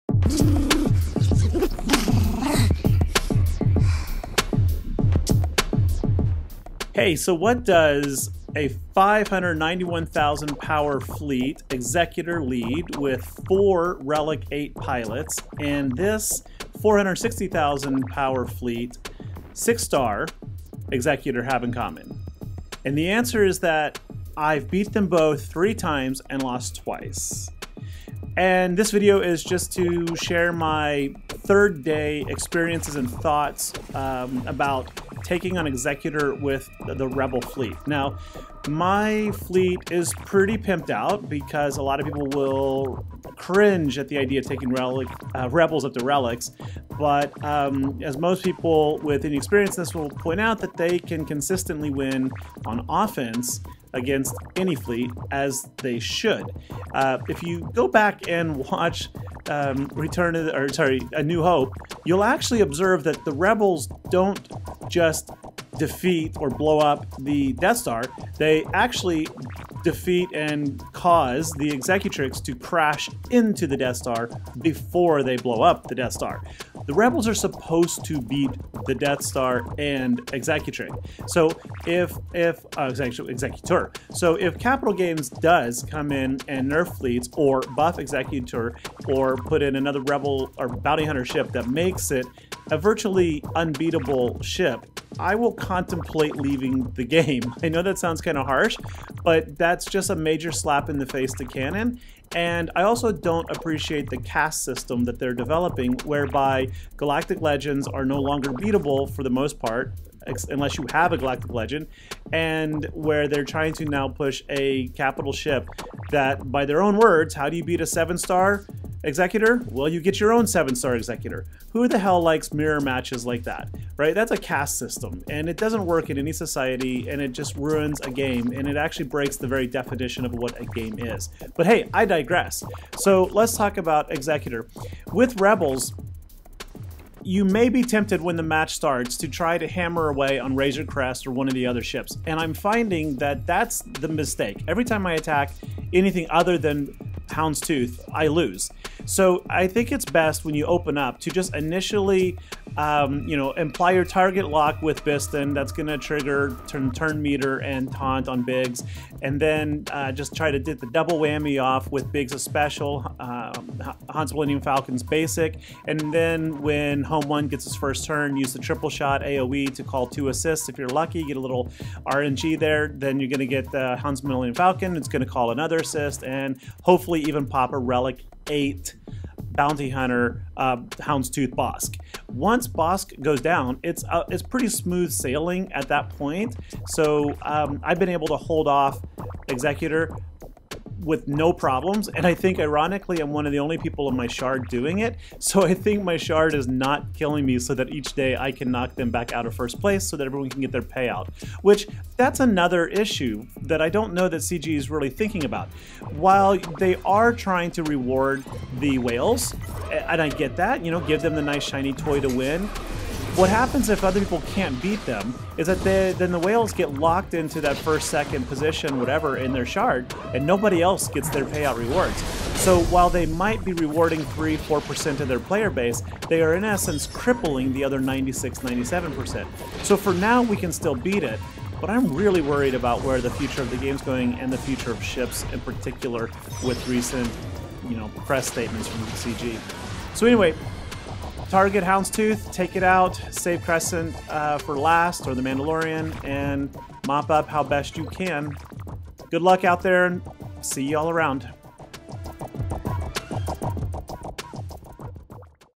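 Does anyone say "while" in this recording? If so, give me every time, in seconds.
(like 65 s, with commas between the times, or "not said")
206 s, 222 s.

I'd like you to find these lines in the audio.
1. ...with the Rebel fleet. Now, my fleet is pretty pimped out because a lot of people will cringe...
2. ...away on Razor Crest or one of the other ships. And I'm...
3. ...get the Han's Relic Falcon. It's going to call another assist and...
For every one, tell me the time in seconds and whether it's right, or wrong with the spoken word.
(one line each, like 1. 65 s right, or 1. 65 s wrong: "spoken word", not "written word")
1. 36 s right
2. 140 s right
3. 173 s wrong: "Millennium", not "Relic".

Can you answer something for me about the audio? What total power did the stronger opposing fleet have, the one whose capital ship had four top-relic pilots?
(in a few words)
591,000.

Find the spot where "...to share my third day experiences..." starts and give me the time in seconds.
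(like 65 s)
29 s.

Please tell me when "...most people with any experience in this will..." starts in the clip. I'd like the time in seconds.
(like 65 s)
48 s.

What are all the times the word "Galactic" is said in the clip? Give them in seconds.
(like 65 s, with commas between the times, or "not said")
106 s, 111 s.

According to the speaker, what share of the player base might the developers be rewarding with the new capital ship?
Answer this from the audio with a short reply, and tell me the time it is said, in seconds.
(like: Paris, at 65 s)
3-4%, at 224 s.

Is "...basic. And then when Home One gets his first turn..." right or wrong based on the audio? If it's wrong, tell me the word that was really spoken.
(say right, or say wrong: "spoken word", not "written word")
right.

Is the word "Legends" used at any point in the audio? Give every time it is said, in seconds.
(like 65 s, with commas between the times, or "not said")
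107 s, 111 s.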